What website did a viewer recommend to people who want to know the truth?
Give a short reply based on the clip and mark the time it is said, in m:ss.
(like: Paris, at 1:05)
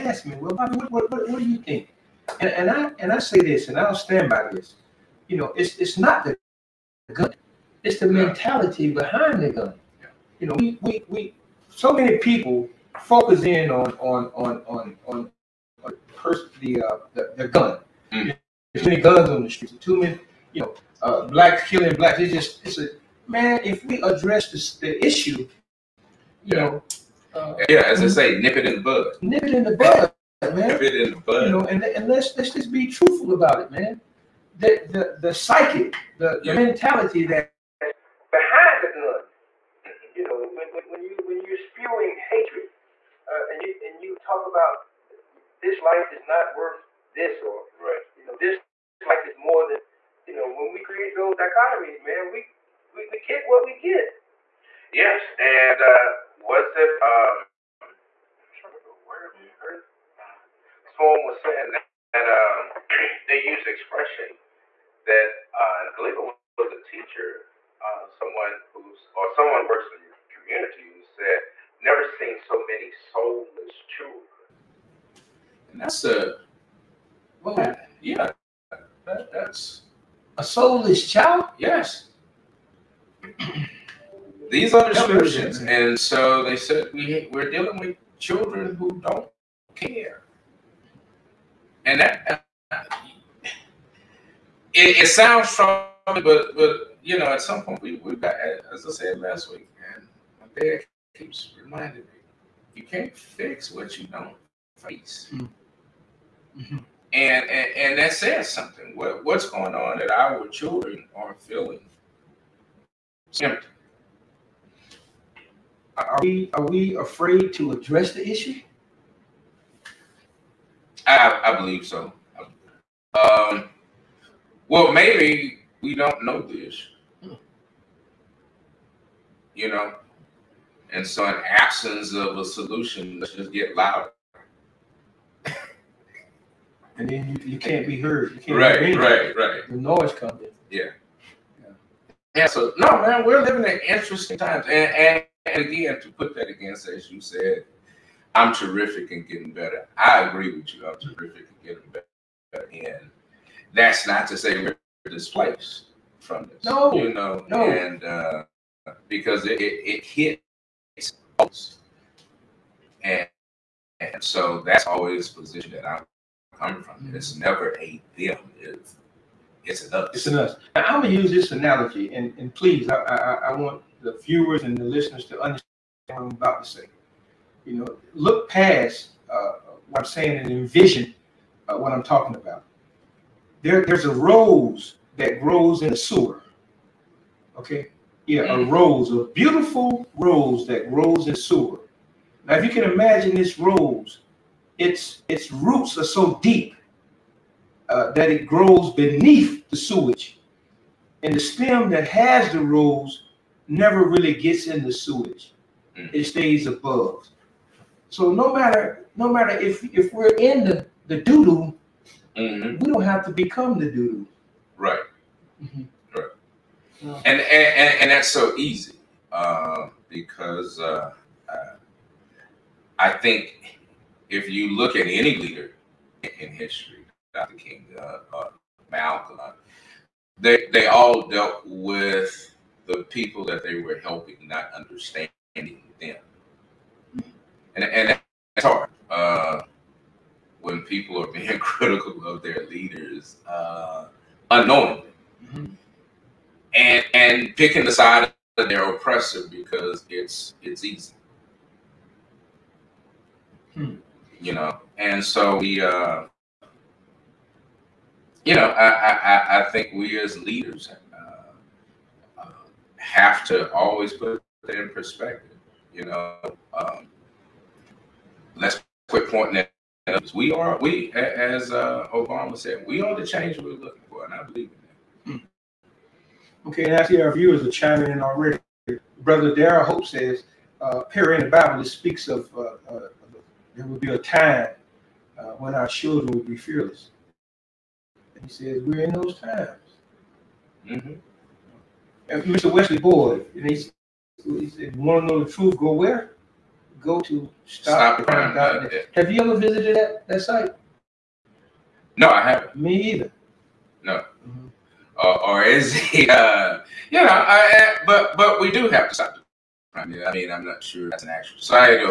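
stopcrime.net, at 4:57.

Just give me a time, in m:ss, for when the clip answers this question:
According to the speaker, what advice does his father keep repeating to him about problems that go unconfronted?
1:42.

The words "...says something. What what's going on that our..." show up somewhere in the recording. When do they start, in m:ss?
1:48.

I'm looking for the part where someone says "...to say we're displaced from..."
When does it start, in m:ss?
2:34.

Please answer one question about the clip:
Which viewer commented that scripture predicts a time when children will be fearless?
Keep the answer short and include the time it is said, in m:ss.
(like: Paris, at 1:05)
Darrell Hope, at 4:39.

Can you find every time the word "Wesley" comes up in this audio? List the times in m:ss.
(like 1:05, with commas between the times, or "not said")
4:52.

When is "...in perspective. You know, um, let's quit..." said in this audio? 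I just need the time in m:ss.
4:24.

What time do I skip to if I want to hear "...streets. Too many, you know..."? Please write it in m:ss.
0:19.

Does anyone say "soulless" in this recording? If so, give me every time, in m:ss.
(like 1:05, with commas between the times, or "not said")
1:12, 1:20.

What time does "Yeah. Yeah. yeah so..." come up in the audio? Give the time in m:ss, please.
2:20.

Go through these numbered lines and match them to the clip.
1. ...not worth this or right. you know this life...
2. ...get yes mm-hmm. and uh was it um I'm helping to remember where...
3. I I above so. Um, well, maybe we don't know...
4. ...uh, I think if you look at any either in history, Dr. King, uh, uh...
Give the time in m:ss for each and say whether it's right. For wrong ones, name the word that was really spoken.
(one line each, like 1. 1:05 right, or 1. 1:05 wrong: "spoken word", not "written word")
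1. 0:46 right
2. 0:53 wrong: "trying", not "helping"
3. 2:01 wrong: "believe", not "above"
4. 3:41 wrong: "leader", not "either".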